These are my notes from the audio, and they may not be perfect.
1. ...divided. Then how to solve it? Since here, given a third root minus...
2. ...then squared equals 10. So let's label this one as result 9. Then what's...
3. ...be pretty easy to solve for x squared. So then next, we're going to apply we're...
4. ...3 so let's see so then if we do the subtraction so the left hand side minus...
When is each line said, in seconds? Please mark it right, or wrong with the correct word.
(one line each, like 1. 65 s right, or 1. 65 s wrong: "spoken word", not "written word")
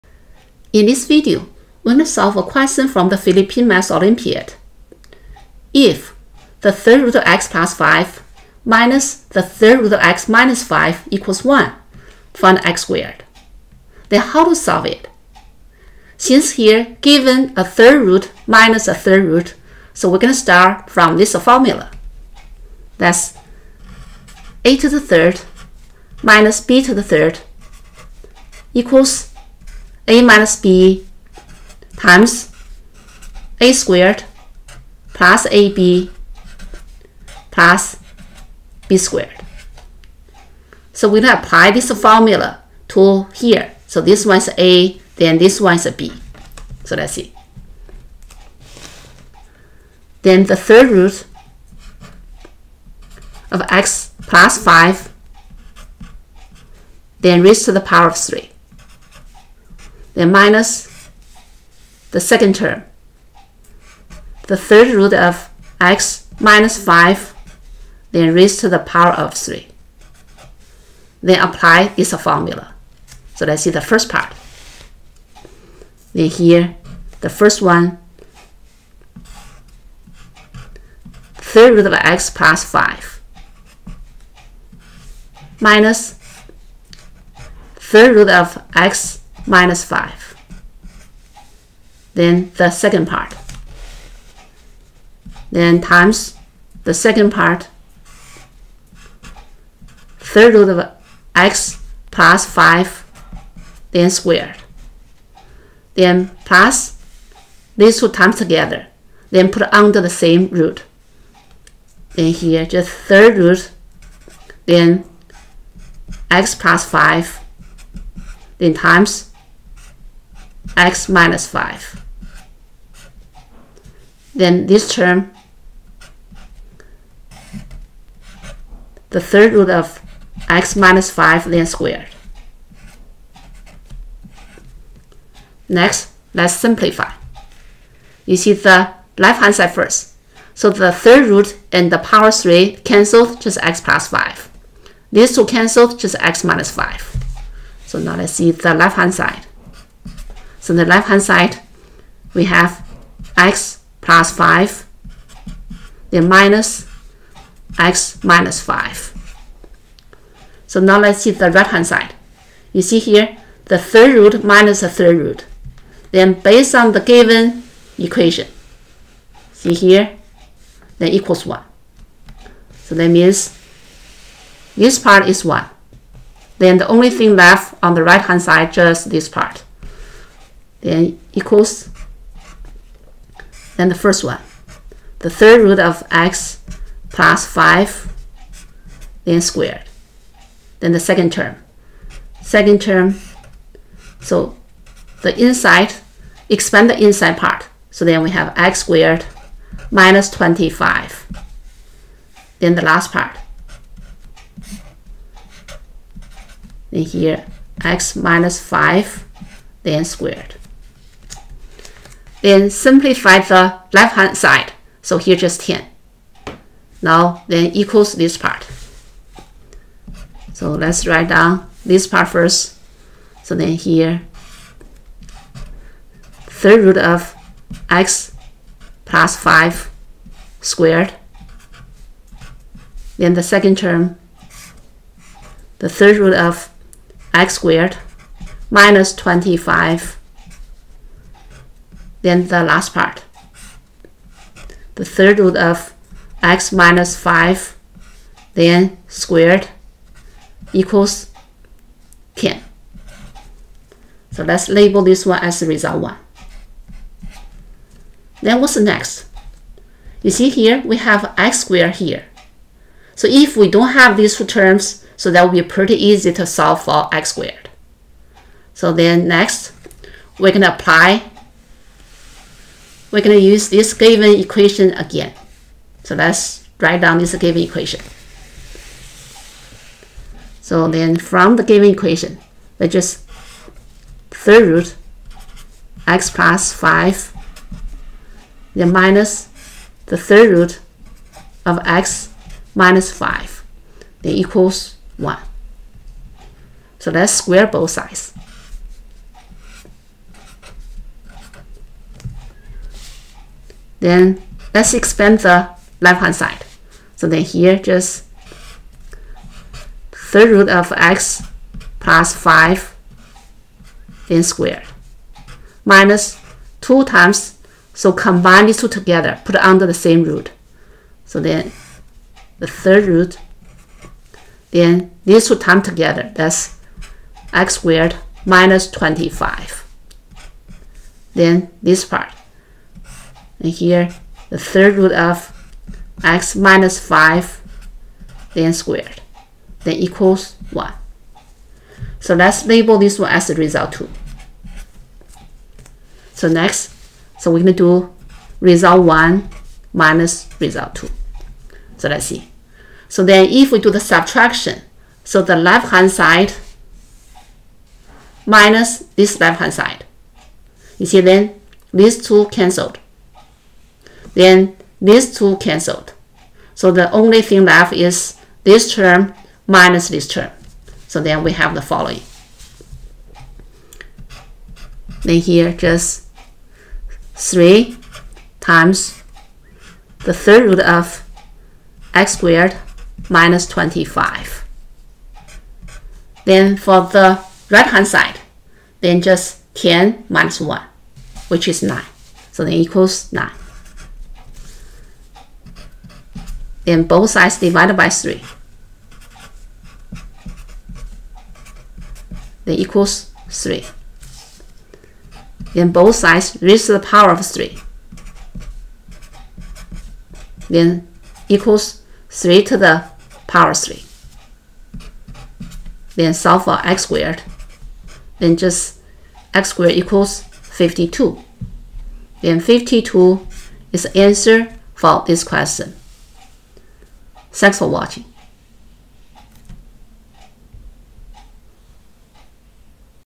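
1. 12 s wrong: "squared", not "divided"
2. 248 s wrong: "1", not "9"
3. 265 s right
4. 350 s wrong: "2", not "3".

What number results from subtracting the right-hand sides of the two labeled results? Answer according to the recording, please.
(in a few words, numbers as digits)
9.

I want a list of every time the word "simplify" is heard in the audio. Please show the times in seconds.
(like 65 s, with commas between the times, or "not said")
136 s, 212 s.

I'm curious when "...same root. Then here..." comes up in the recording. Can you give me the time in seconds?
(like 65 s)
110 s.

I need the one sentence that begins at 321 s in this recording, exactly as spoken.
So then the third root, then these two times together, that's x squared minus 25.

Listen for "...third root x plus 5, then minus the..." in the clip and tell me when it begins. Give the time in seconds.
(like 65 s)
284 s.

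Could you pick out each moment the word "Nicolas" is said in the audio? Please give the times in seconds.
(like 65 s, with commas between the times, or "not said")
not said.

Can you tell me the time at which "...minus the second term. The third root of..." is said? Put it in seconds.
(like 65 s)
60 s.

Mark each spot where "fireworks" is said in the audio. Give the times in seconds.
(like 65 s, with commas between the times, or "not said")
not said.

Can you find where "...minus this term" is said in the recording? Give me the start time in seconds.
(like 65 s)
369 s.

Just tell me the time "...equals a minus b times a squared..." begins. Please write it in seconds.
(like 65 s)
28 s.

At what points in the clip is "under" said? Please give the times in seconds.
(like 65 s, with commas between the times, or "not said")
109 s, 319 s.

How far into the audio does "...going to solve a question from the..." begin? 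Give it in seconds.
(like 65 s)
1 s.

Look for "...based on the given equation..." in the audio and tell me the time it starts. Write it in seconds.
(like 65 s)
166 s.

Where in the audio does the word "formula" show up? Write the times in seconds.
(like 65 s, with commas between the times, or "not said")
21 s, 41 s, 72 s.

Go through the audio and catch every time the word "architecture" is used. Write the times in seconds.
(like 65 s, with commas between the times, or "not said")
not said.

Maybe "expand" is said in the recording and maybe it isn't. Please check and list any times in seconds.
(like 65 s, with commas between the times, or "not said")
196 s, 304 s.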